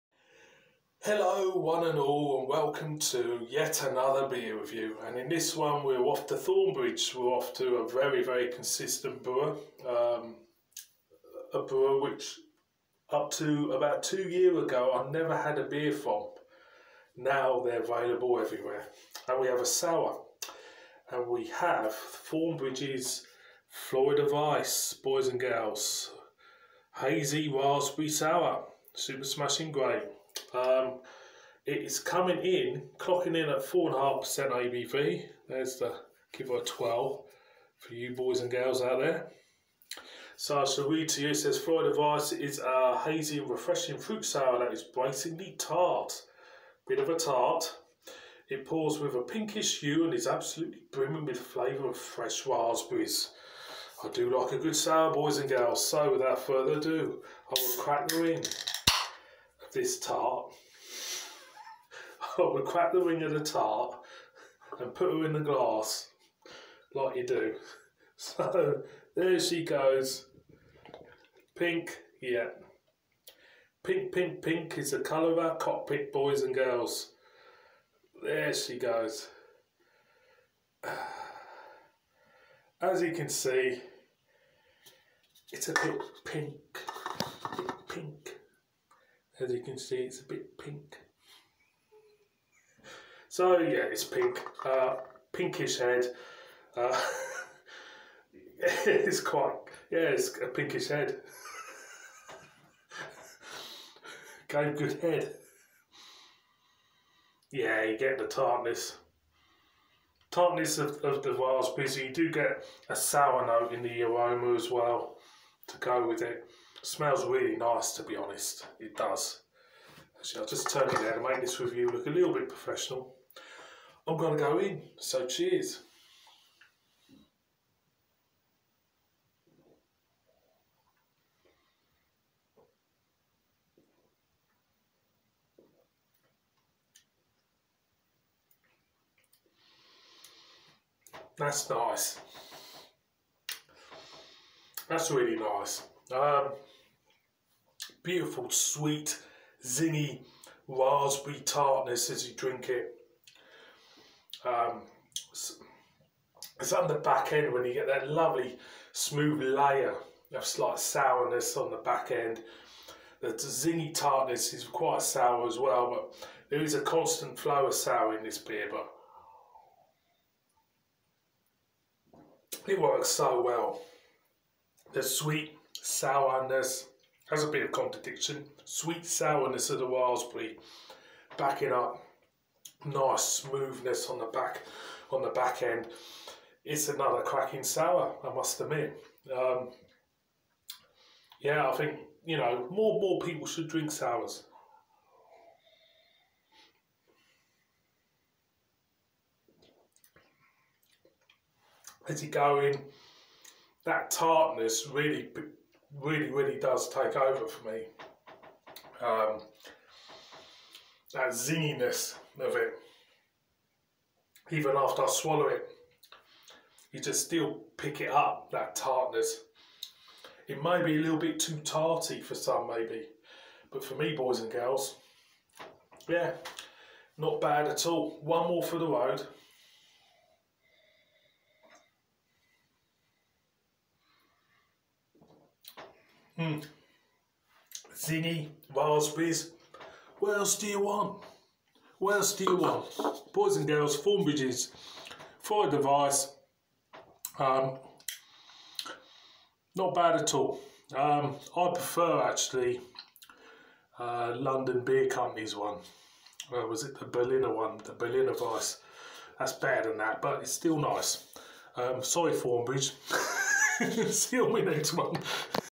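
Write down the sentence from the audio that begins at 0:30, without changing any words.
Um, it is coming in, clocking in at 4.5% ABV.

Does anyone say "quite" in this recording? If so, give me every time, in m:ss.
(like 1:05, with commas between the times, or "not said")
1:39, 2:44.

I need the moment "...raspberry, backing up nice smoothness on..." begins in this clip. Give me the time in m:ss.
2:59.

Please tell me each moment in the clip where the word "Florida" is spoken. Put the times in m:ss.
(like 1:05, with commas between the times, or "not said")
0:23, 0:41.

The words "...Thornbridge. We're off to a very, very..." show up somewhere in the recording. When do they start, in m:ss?
0:06.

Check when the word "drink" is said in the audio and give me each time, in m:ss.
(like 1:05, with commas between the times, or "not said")
2:32, 3:13.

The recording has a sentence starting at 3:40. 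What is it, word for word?
It may be a little bit too tarty for some, maybe, but for me, boys and girls, yeah, not bad at all.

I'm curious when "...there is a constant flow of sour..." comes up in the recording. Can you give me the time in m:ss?
2:46.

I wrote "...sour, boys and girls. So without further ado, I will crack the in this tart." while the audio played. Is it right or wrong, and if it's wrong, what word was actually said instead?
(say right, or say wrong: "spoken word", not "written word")
right.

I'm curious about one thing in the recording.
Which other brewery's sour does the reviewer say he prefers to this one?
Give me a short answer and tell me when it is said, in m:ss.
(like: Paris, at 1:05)
London Beer Company, at 4:14.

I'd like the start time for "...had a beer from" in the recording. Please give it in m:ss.
0:15.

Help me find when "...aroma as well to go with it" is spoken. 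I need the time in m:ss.
1:54.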